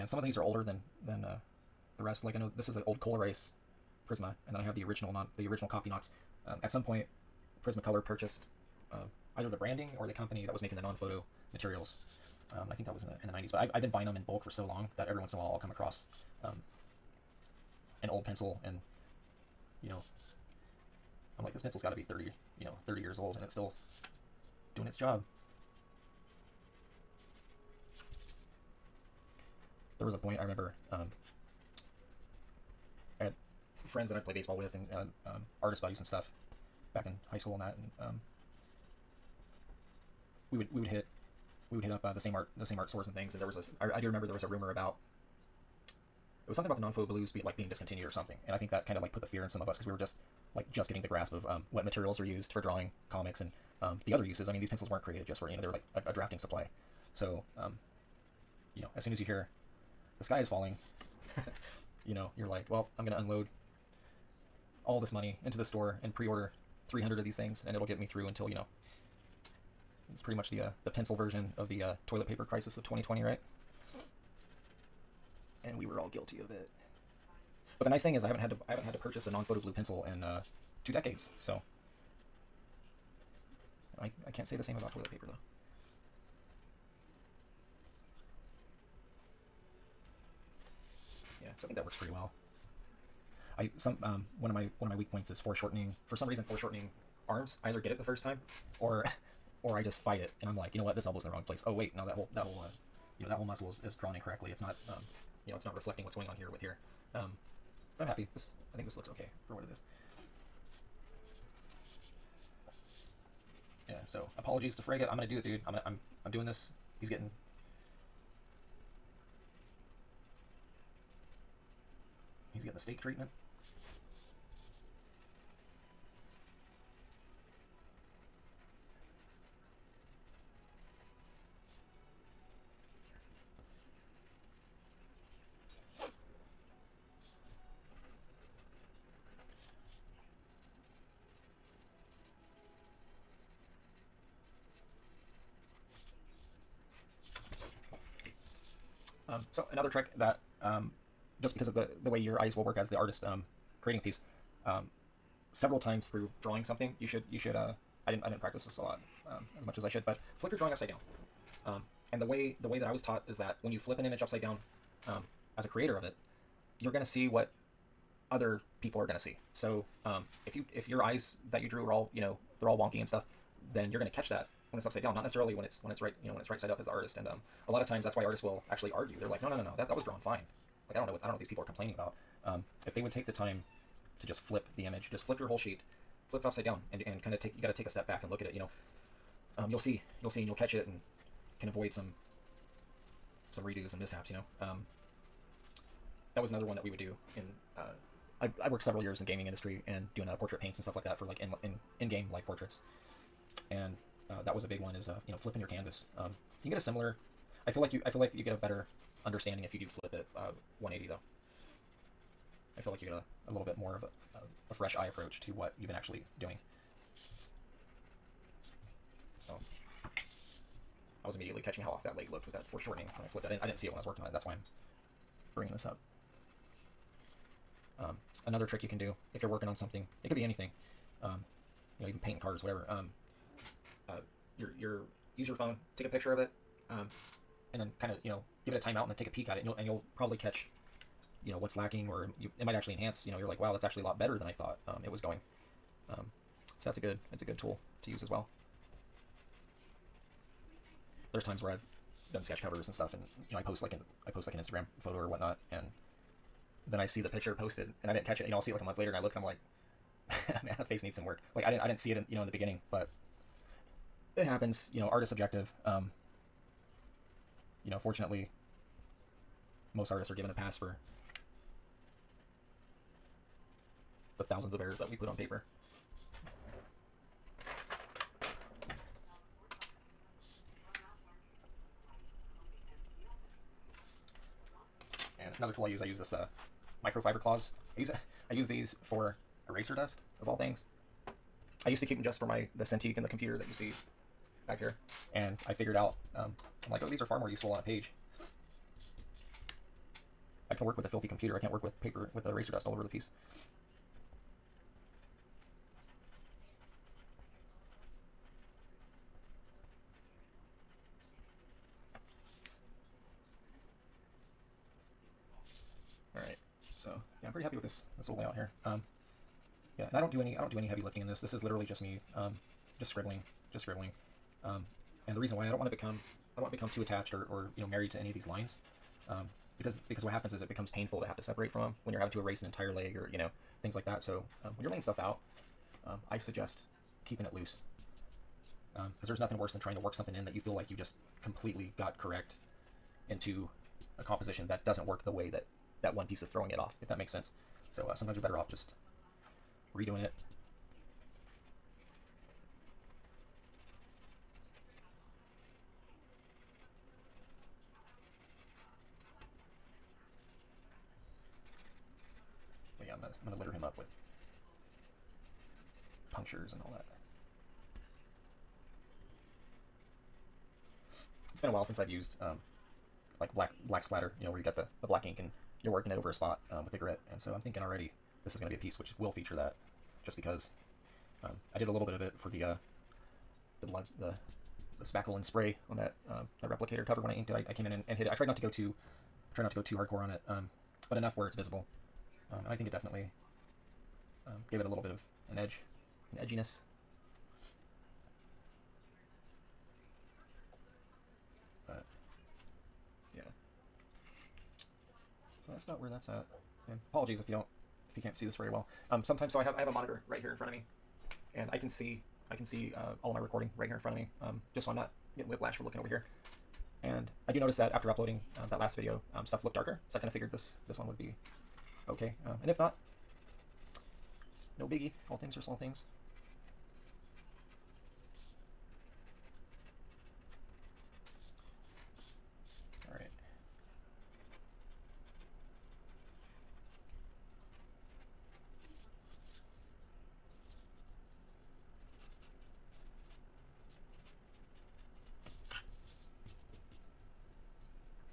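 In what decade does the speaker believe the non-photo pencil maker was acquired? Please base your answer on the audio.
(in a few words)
the 90s.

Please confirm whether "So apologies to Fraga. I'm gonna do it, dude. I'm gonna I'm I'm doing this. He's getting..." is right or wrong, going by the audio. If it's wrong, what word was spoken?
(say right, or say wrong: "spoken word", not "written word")
right.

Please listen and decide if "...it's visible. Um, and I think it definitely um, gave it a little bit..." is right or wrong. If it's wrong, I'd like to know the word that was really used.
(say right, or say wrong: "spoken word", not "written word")
right.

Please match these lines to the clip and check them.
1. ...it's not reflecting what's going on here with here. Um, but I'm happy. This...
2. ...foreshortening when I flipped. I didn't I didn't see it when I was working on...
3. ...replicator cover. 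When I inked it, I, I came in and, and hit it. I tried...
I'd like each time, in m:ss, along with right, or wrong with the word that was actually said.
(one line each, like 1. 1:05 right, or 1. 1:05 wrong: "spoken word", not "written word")
1. 1:45 right
2. 3:42 right
3. 6:26 right.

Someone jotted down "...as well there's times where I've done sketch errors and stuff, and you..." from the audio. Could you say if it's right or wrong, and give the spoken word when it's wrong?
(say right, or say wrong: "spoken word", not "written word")
wrong: "covers", not "errors".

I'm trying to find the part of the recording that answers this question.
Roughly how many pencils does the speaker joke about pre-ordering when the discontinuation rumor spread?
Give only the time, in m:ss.
1:06.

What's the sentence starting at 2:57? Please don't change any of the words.
And um, a lot of times that's why artists will actually argue.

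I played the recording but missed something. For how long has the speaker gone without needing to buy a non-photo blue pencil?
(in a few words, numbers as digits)
two decades.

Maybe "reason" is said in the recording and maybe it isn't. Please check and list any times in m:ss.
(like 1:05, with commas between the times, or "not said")
1:36, 5:25.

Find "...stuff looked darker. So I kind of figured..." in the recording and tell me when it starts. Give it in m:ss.
6:59.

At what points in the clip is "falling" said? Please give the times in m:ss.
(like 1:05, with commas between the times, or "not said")
1:00.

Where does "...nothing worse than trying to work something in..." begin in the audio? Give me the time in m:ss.
5:39.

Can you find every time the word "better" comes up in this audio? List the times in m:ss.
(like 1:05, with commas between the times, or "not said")
3:28, 4:04, 5:48.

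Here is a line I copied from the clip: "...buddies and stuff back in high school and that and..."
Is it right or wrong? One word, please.
right.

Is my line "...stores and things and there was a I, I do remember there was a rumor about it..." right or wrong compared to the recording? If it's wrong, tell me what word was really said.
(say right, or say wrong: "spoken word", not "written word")
right.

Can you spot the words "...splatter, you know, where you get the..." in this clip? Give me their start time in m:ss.
6:14.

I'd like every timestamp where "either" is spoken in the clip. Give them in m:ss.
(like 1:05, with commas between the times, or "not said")
0:09, 1:37.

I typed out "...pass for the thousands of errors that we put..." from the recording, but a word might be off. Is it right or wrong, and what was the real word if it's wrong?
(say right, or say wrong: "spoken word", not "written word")
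right.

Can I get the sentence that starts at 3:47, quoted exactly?
Um, another trick you can do if you're working on something, it could be anything.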